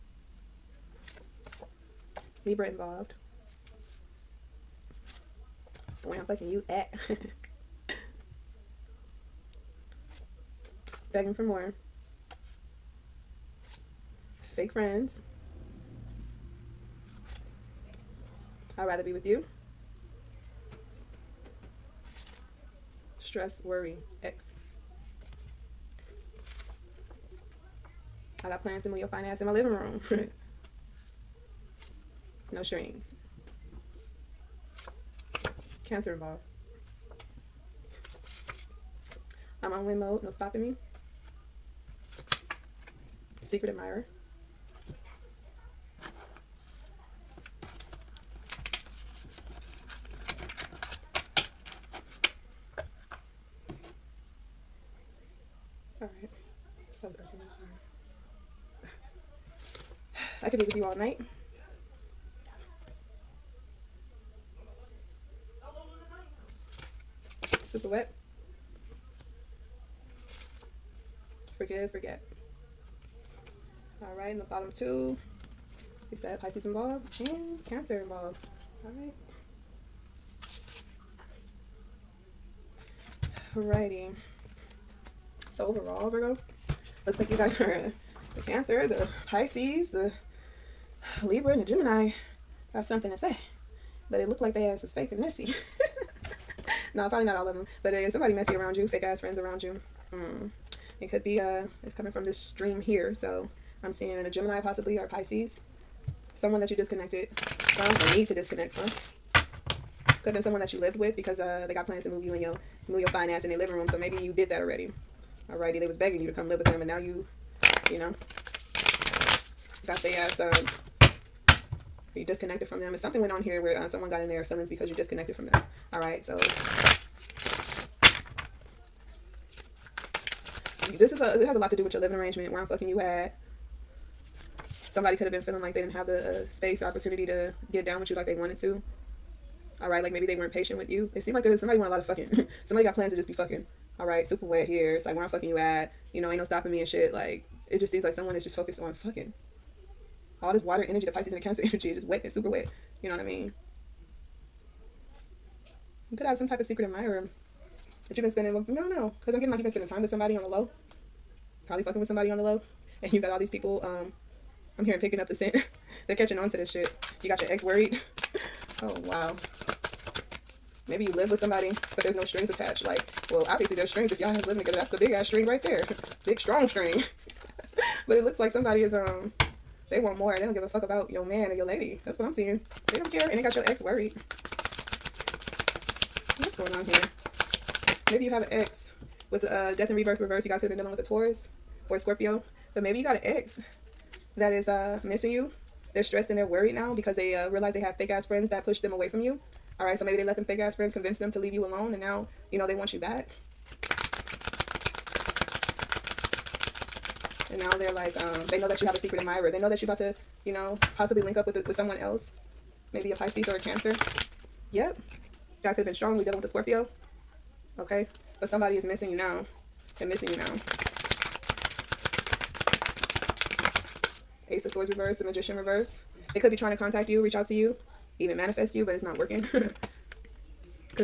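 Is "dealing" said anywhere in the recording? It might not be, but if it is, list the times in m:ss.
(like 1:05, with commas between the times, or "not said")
3:10, 3:36.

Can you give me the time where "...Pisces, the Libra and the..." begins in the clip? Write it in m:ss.
1:29.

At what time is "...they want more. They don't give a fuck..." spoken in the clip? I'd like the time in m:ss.
2:59.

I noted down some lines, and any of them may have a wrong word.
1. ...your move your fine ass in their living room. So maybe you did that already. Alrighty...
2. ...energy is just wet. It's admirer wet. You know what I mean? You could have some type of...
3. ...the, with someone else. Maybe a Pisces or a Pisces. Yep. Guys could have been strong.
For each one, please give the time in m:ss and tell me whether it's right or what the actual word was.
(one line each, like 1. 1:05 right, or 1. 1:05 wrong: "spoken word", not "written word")
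1. 1:52 right
2. 2:31 wrong: "super", not "admirer"
3. 3:31 wrong: "Cancer", not "Pisces".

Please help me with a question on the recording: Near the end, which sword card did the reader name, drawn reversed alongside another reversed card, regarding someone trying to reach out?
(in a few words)
Ace of Swords.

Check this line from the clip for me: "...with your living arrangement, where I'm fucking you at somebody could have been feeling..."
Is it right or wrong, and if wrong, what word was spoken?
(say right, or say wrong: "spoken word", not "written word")
right.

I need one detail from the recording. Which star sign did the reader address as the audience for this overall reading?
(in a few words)
Virgo.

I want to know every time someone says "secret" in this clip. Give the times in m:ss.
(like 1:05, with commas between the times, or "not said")
0:43, 2:36, 3:28.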